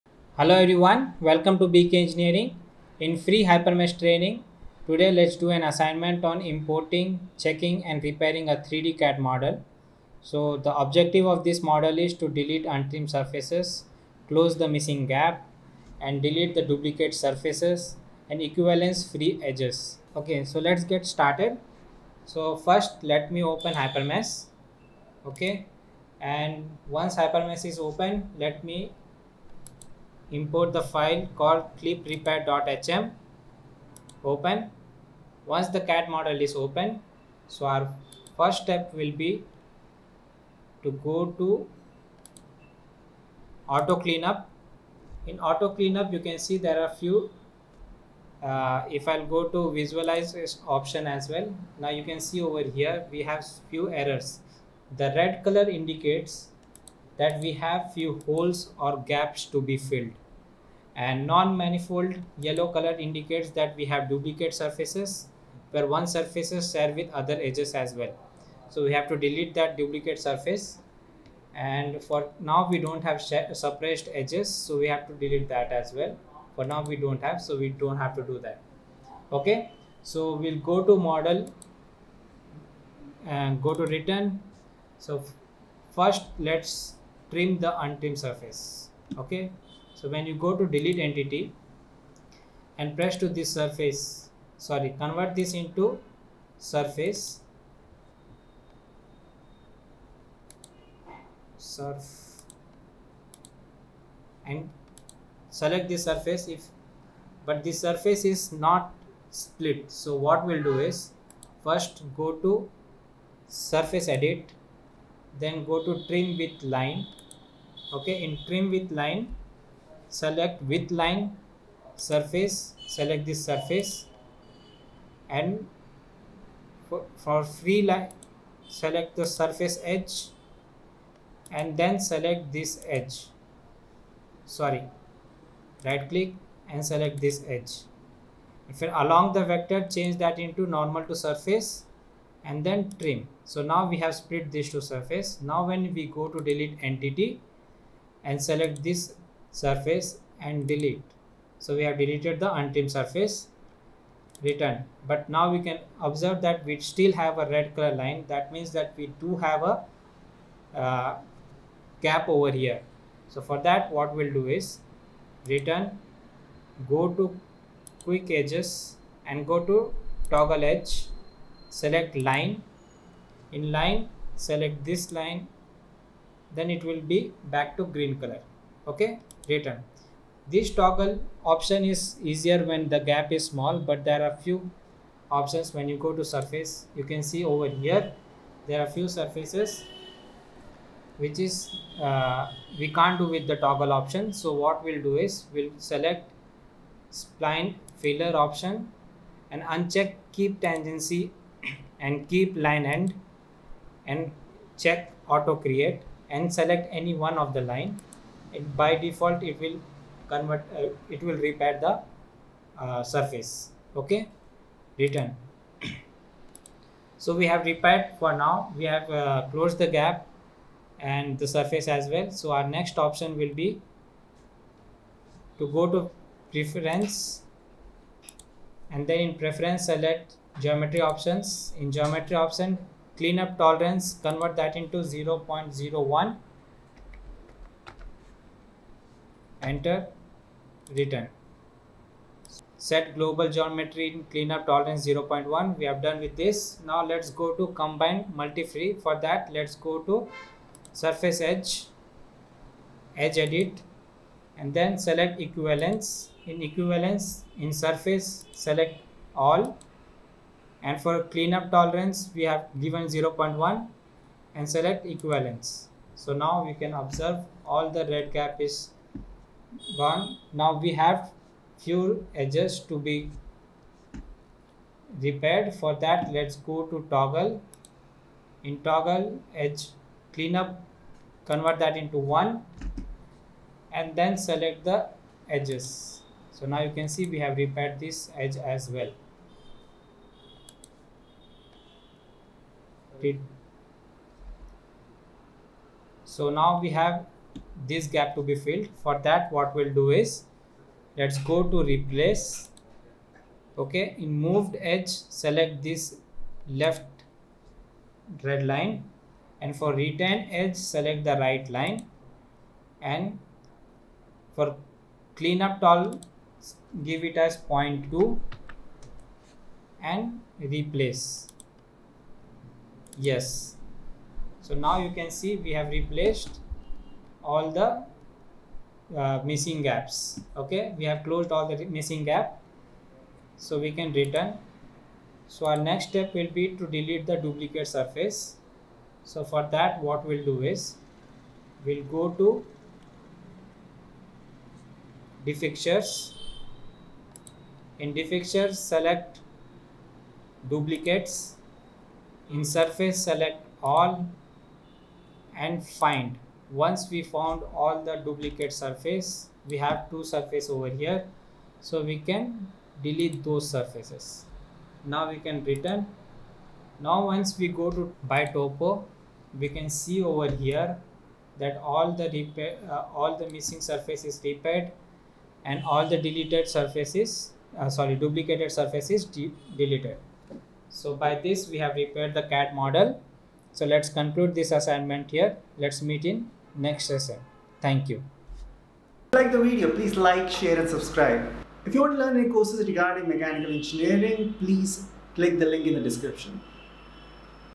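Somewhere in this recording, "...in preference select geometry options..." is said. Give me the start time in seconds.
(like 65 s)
229 s.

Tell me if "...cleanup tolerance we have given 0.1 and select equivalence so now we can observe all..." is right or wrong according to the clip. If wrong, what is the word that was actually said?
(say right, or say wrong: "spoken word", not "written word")
right.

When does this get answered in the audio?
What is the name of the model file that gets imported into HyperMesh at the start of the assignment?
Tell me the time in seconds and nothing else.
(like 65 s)
31 s.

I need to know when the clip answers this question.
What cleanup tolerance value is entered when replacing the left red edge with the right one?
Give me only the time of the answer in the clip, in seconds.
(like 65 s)
317 s.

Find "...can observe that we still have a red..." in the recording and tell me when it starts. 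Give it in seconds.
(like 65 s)
155 s.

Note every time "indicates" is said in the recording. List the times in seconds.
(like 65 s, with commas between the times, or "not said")
55 s, 62 s.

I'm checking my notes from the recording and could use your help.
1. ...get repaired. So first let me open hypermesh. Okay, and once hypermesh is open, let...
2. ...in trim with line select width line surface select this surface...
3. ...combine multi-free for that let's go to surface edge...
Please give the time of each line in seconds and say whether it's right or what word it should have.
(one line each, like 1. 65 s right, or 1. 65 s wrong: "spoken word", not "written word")
1. 20 s wrong: "started", not "repaired"
2. 118 s right
3. 247 s right.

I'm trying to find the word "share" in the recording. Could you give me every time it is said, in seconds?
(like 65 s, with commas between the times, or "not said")
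66 s, 390 s.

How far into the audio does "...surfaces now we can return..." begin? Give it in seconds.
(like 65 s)
363 s.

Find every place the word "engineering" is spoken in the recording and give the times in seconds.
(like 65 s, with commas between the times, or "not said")
2 s, 393 s.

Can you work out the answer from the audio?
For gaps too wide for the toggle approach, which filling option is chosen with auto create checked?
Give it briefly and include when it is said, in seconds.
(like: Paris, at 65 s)
Spline filler, at 197 s.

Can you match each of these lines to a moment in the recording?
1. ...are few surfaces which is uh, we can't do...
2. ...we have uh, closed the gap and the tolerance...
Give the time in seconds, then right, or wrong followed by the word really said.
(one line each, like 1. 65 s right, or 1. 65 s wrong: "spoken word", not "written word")
1. 188 s right
2. 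218 s wrong: "surface", not "tolerance".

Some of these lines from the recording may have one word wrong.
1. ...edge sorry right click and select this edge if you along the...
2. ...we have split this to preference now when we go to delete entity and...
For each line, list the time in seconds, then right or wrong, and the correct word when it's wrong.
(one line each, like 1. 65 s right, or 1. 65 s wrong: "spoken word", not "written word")
1. 132 s right
2. 143 s wrong: "surface", not "preference".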